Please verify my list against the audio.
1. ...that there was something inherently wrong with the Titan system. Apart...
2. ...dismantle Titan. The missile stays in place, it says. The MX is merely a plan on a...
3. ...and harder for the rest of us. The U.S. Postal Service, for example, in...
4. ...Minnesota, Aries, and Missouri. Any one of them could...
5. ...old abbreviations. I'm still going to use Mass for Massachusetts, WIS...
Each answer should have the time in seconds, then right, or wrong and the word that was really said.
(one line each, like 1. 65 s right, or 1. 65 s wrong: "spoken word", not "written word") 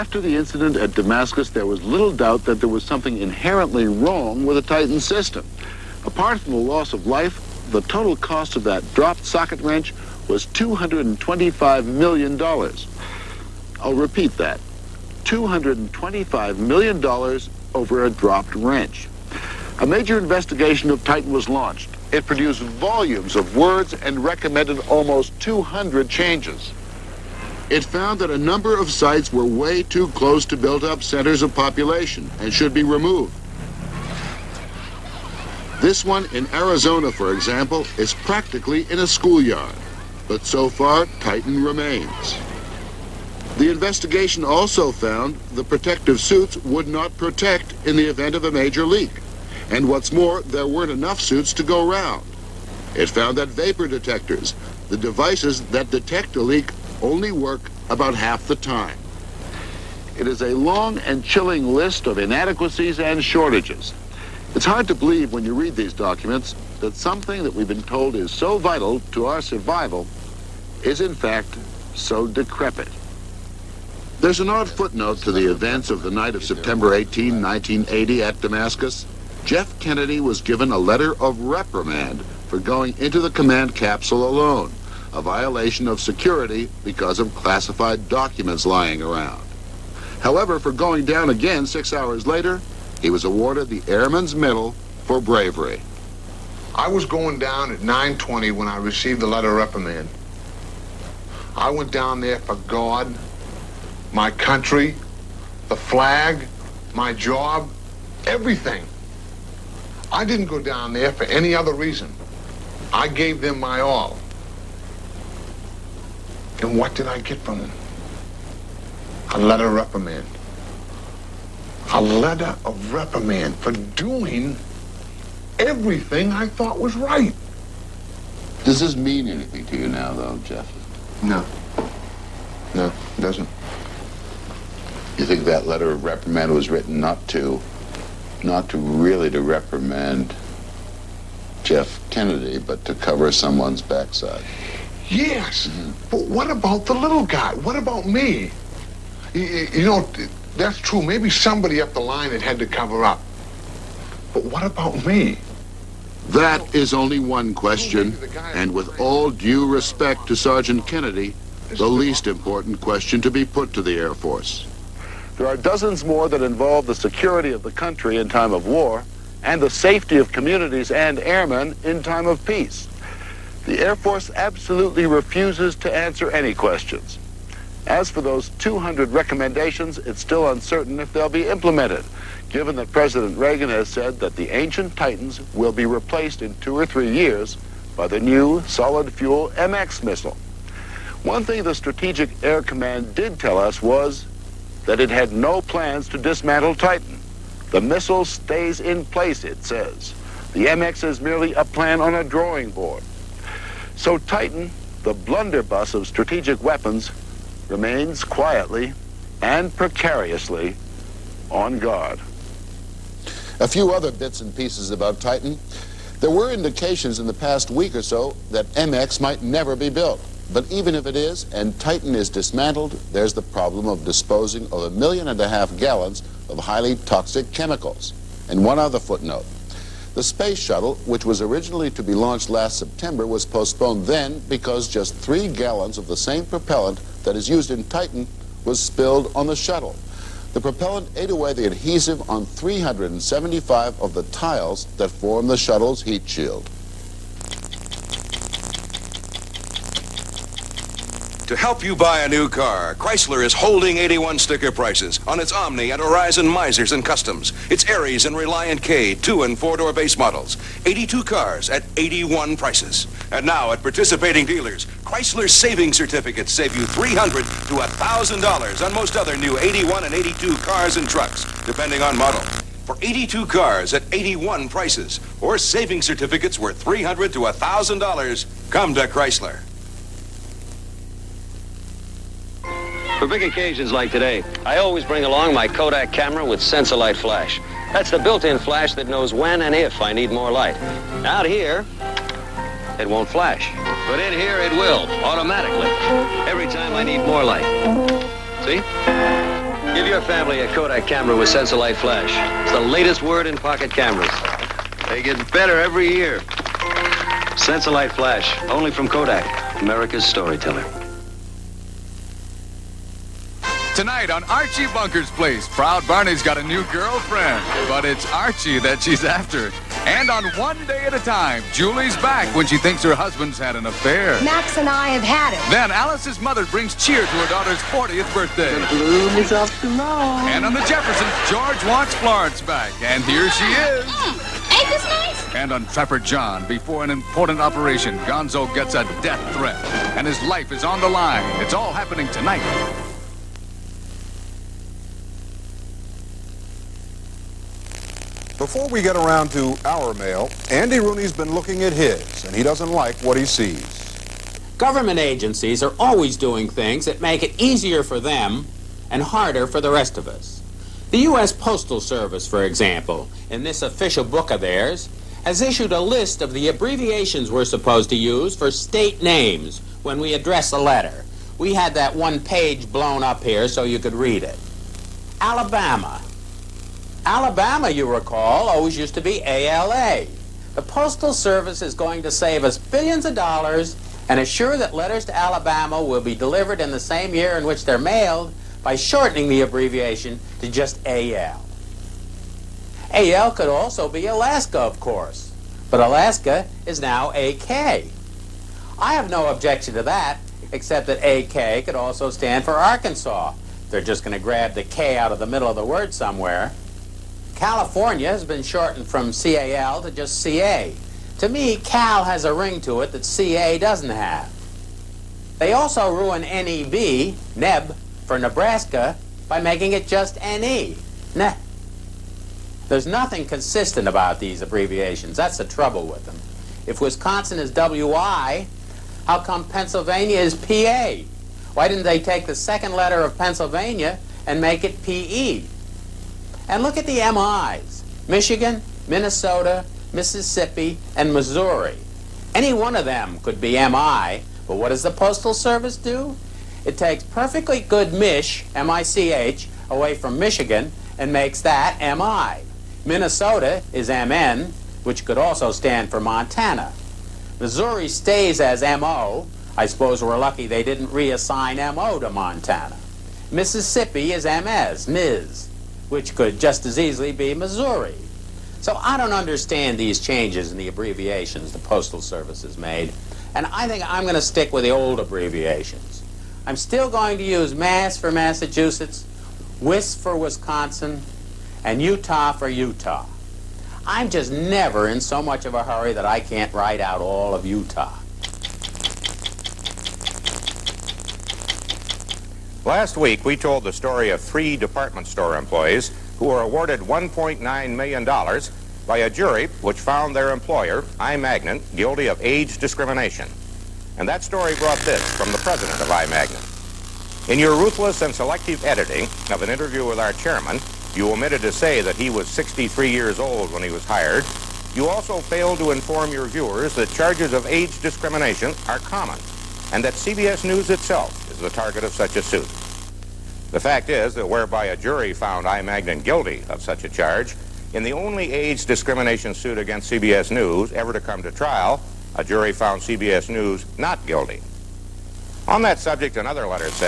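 1. 2 s right
2. 196 s right
3. 359 s right
4. 439 s wrong: "Mississippi", not "Aries"
5. 474 s right.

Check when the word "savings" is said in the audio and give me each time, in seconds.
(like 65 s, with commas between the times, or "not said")
265 s, 275 s.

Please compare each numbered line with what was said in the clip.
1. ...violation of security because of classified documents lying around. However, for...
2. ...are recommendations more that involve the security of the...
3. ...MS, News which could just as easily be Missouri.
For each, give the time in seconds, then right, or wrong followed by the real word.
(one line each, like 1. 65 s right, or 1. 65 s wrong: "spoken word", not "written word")
1. 85 s right
2. 165 s wrong: "dozens", not "recommendations"
3. 464 s wrong: "MIS", not "News".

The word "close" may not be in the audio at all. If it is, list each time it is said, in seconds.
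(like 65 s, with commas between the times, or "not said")
30 s.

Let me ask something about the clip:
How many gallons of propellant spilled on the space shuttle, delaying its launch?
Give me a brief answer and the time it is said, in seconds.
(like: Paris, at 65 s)
3, at 235 s.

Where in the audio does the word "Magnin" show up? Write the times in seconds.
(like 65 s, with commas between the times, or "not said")
501 s, 506 s, 525 s.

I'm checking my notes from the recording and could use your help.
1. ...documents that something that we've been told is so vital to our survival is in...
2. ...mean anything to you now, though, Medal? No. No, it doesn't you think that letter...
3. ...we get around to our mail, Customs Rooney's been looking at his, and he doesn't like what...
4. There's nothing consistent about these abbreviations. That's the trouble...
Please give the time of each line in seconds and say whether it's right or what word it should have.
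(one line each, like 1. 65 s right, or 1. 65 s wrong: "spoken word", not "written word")
1. 65 s right
2. 128 s wrong: "Jeff", not "Medal"
3. 348 s wrong: "Andy", not "Customs"
4. 422 s right.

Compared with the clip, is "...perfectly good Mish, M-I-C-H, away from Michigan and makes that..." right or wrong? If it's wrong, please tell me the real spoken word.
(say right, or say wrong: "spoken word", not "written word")
right.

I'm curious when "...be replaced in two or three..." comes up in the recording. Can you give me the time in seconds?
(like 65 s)
185 s.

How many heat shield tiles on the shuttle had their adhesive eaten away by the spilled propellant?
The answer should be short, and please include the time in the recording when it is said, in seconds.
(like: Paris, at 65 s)
375, at 242 s.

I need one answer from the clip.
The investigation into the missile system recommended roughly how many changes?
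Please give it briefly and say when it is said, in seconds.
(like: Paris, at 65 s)
almost 200, at 24 s.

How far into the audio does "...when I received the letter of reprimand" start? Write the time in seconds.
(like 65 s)
98 s.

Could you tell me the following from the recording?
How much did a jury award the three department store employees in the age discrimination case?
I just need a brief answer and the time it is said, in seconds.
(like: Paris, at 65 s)
$1.9 million, at 496 s.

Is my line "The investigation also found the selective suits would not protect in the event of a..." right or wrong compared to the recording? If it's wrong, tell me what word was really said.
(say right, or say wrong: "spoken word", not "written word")
wrong: "protective", not "selective".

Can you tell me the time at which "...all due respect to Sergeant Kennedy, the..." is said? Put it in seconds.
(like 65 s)
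158 s.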